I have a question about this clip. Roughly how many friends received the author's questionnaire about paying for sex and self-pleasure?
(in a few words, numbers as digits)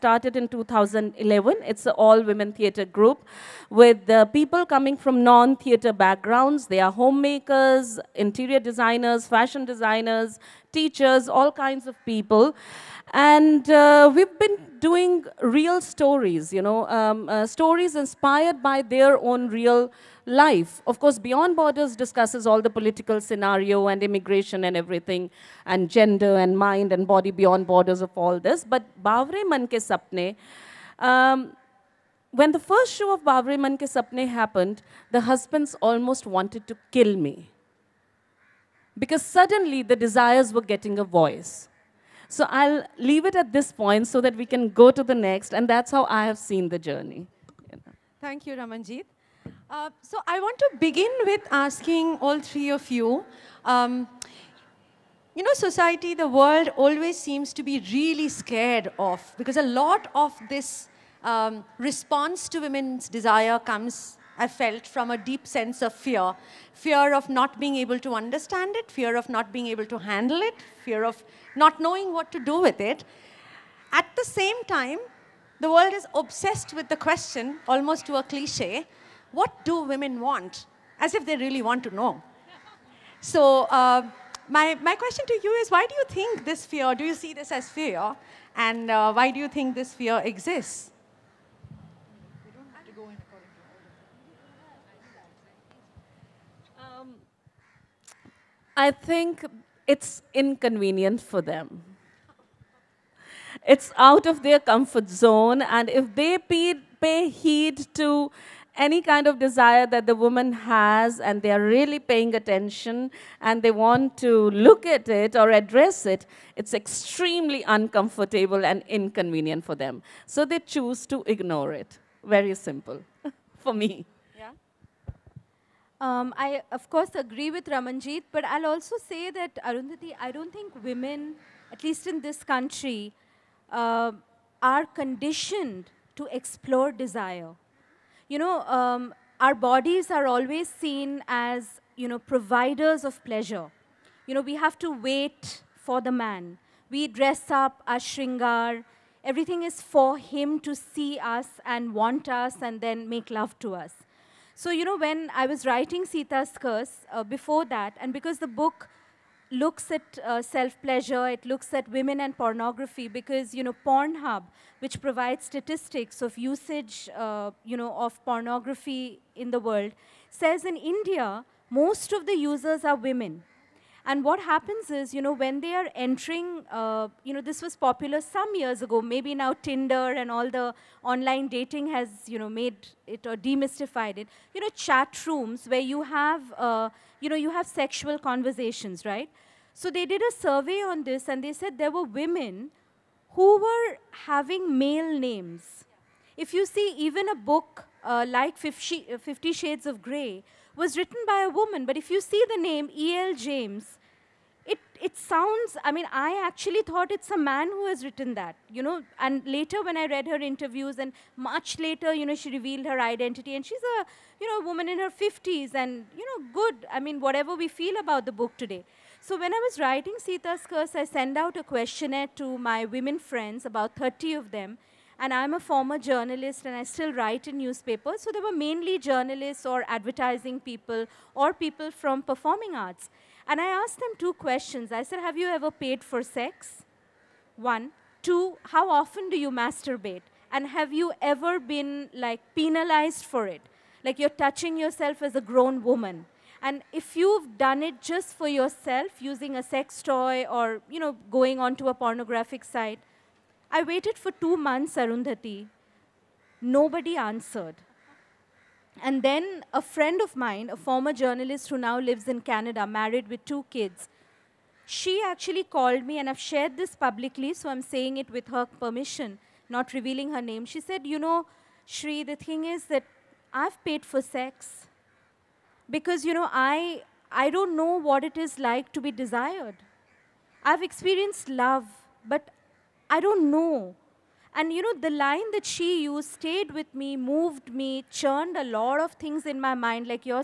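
30.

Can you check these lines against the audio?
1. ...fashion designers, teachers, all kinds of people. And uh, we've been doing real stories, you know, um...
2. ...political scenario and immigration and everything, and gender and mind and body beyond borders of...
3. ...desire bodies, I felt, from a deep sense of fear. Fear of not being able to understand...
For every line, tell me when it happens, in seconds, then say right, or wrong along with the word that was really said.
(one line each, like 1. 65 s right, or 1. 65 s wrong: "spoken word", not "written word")
1. 9 s right
2. 22 s right
3. 63 s wrong: "comes", not "bodies".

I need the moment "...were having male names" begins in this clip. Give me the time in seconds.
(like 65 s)
193 s.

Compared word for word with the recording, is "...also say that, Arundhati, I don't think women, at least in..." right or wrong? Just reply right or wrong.
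right.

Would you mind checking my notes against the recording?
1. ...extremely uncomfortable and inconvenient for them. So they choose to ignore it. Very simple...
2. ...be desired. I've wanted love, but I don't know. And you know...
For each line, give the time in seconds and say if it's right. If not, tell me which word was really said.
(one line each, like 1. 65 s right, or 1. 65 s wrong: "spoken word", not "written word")
1. 116 s right
2. 279 s wrong: "experienced", not "wanted".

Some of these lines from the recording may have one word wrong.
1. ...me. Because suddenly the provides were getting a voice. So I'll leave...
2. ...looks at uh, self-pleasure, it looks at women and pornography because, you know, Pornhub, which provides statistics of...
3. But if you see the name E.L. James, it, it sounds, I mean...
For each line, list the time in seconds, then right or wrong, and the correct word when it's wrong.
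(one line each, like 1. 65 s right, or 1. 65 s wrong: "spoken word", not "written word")
1. 37 s wrong: "desires", not "provides"
2. 159 s right
3. 201 s right.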